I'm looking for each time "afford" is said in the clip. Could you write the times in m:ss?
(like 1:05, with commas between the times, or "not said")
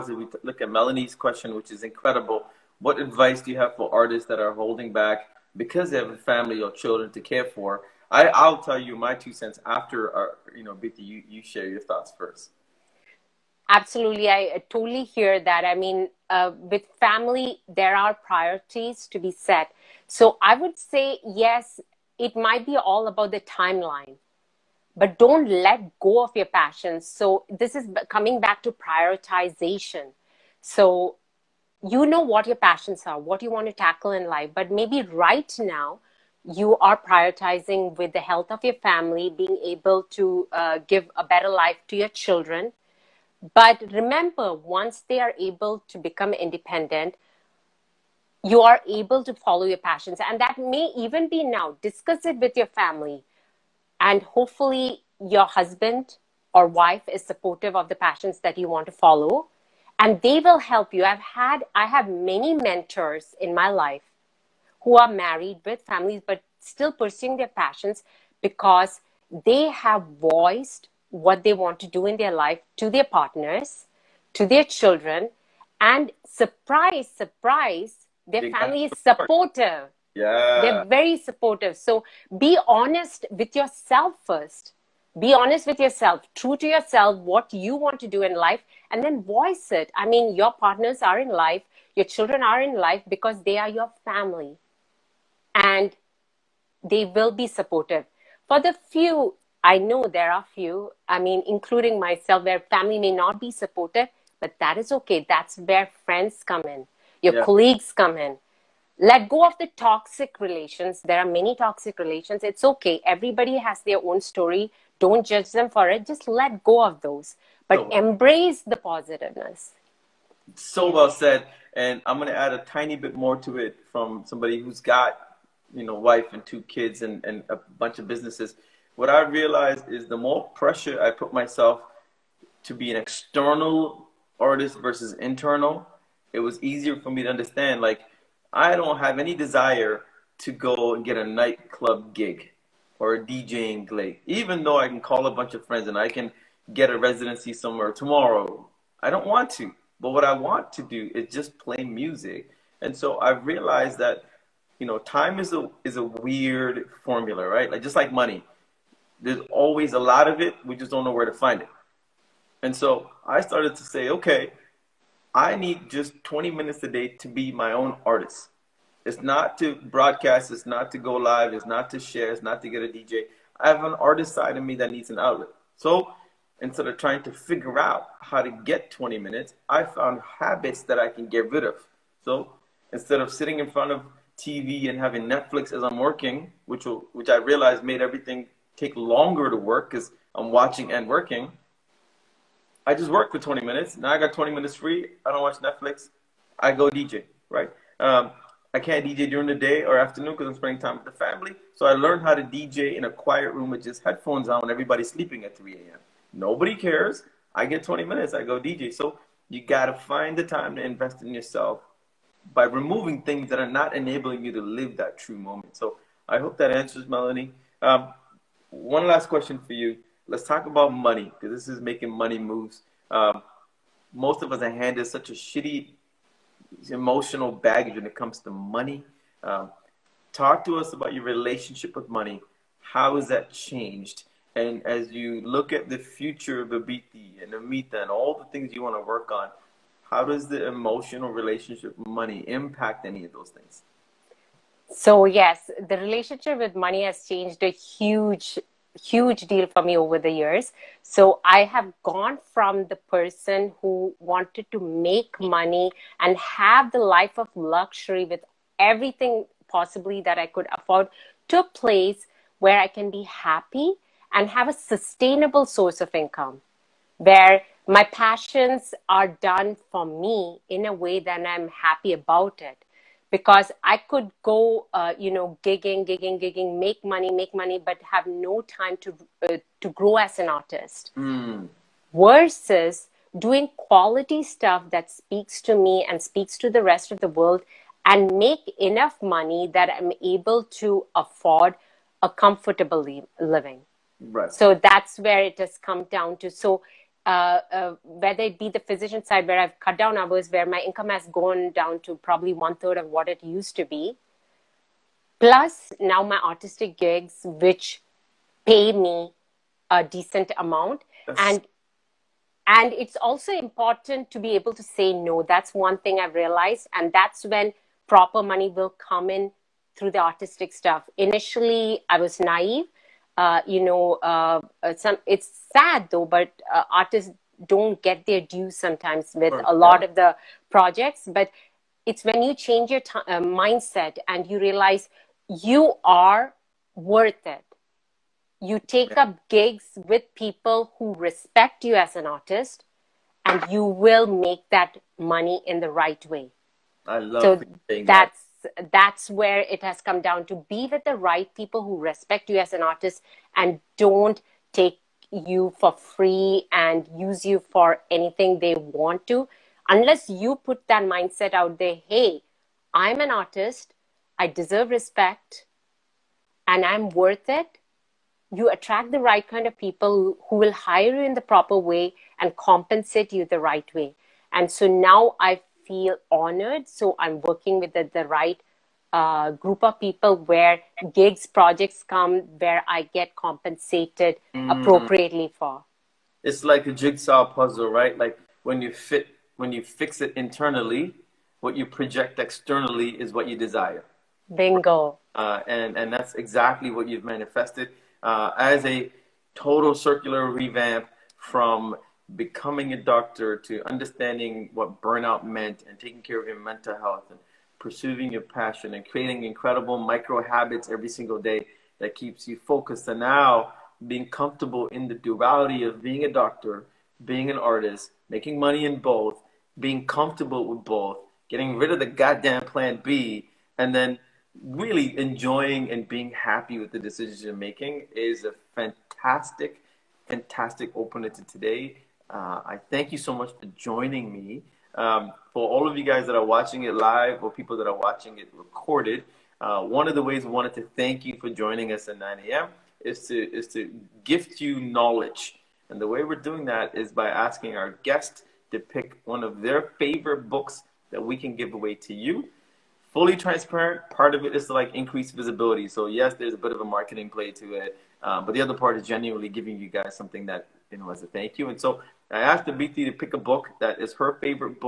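4:20, 4:51.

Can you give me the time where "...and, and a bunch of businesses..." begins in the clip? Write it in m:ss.
2:07.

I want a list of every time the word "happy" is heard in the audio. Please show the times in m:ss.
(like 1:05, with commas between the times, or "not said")
4:23, 4:31, 7:06.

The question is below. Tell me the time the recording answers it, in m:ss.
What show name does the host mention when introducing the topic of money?
3:41.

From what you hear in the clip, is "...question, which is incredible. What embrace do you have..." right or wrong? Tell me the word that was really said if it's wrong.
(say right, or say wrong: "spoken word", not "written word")
wrong: "advice", not "embrace".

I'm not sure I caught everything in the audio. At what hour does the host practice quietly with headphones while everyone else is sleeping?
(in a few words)
3 a.m.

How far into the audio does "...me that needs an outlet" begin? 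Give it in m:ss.
2:54.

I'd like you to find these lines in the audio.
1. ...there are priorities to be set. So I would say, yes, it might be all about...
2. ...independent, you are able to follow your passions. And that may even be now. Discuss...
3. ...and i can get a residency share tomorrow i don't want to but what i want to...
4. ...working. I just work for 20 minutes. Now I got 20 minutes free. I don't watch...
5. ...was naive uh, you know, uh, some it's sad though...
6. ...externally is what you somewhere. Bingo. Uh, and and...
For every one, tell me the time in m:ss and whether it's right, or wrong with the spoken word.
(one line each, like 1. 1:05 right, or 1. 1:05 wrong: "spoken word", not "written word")
1. 0:17 right
2. 0:46 right
3. 2:25 wrong: "somewhere", not "share"
4. 3:11 right
5. 5:22 right
6. 6:32 wrong: "desire", not "somewhere".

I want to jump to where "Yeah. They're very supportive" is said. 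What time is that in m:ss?
1:20.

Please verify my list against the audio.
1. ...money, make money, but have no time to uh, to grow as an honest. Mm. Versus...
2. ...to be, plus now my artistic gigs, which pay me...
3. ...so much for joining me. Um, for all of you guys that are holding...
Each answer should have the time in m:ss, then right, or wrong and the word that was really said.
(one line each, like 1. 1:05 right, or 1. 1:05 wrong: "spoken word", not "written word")
1. 4:37 wrong: "artist", not "honest"
2. 5:03 right
3. 7:13 wrong: "watching", not "holding".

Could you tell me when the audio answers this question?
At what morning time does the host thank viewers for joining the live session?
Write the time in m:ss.
7:22.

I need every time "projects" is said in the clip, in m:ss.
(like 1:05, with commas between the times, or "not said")
5:30, 6:21, 6:31.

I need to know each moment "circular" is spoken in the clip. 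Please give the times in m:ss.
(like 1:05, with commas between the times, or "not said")
6:39.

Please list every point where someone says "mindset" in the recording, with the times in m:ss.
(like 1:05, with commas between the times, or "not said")
5:33, 6:01.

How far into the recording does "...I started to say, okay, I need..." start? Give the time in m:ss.
2:43.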